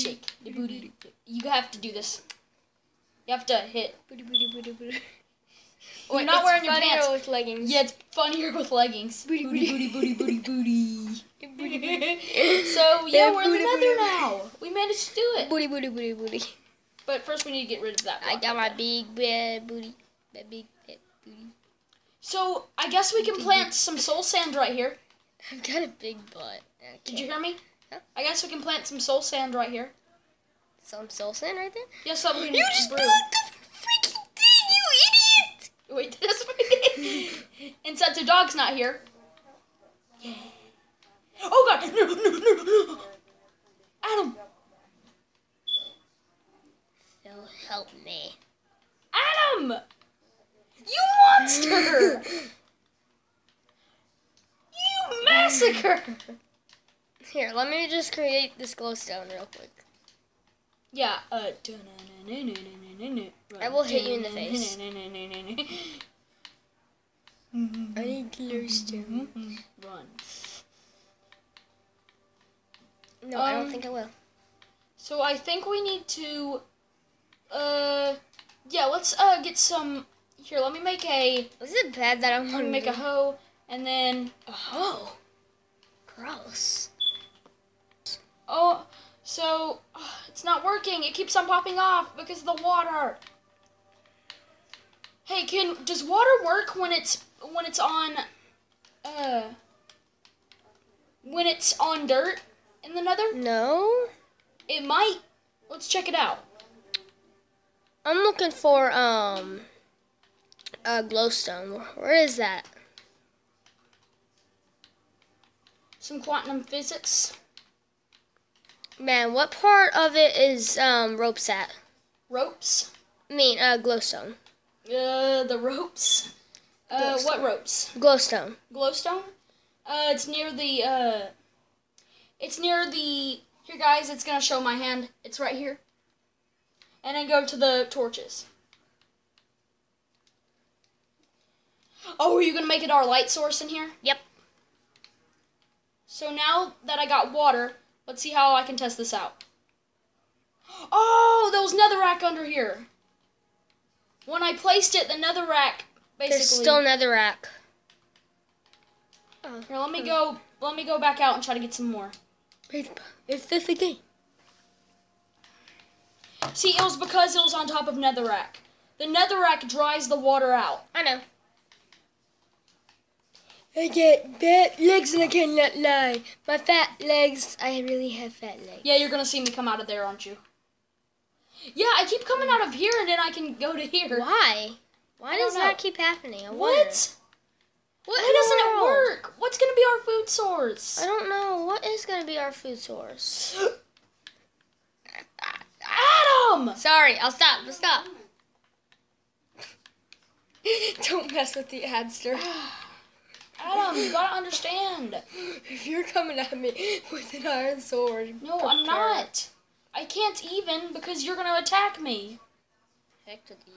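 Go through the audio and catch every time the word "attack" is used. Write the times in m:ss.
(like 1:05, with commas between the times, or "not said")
3:31.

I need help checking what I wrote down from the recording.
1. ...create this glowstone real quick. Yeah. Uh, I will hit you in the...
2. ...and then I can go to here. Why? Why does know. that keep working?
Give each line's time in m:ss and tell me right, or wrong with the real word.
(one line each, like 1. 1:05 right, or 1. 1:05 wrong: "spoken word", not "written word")
1. 0:58 right
2. 3:02 wrong: "happening", not "working".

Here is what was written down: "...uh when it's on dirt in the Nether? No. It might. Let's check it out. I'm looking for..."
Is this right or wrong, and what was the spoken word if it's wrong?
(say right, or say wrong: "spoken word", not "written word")
right.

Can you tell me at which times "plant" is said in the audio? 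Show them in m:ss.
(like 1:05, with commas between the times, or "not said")
0:23, 0:28.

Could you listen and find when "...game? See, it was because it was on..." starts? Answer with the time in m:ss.
2:43.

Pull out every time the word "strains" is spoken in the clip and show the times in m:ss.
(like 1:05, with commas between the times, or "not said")
not said.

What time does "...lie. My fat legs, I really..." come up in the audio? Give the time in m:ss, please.
2:55.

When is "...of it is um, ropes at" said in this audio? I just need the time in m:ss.
1:59.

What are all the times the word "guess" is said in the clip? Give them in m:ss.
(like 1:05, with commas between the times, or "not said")
0:22, 0:28.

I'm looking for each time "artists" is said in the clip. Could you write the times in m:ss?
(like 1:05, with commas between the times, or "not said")
not said.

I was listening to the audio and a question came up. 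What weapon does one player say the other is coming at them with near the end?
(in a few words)
Iron sword.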